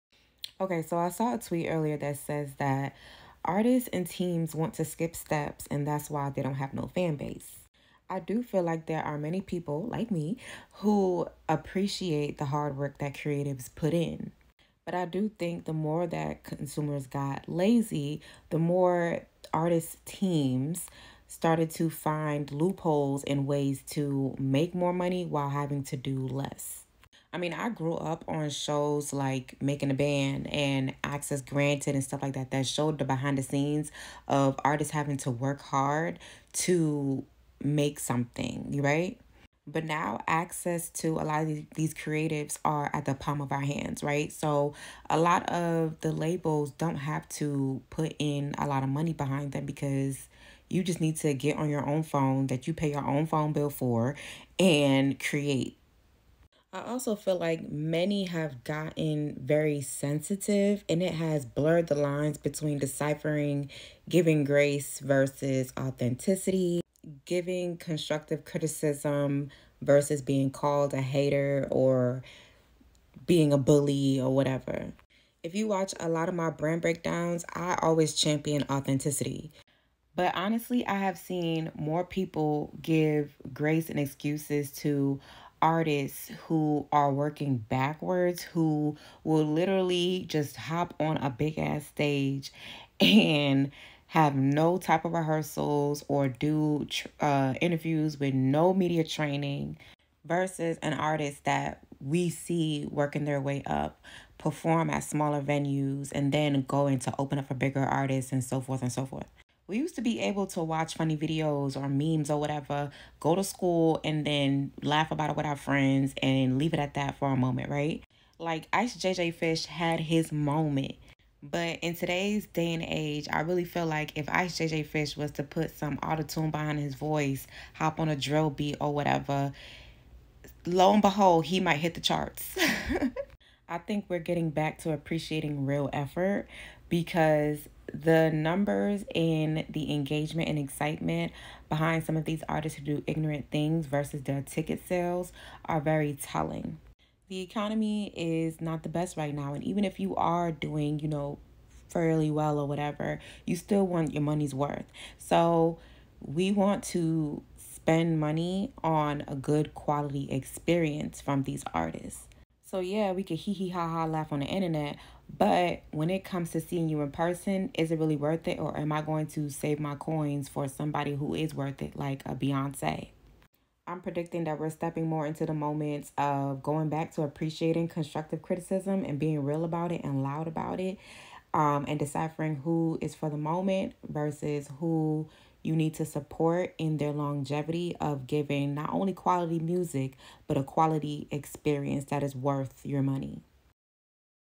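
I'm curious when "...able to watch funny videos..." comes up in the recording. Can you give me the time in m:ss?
1:50.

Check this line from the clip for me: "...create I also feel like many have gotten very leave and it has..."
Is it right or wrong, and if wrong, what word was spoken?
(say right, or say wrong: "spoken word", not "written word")
wrong: "sensitive", not "leave".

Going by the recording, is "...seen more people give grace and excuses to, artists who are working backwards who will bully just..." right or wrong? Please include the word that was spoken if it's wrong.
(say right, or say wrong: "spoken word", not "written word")
wrong: "literally", not "bully".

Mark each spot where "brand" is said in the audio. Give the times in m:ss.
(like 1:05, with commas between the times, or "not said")
1:16.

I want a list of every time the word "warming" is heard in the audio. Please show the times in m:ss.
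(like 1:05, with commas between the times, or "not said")
not said.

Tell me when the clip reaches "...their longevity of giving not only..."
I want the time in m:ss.
3:06.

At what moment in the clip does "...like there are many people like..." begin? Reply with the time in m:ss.
0:08.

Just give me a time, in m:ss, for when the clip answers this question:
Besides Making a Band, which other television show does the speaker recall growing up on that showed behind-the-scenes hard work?
0:31.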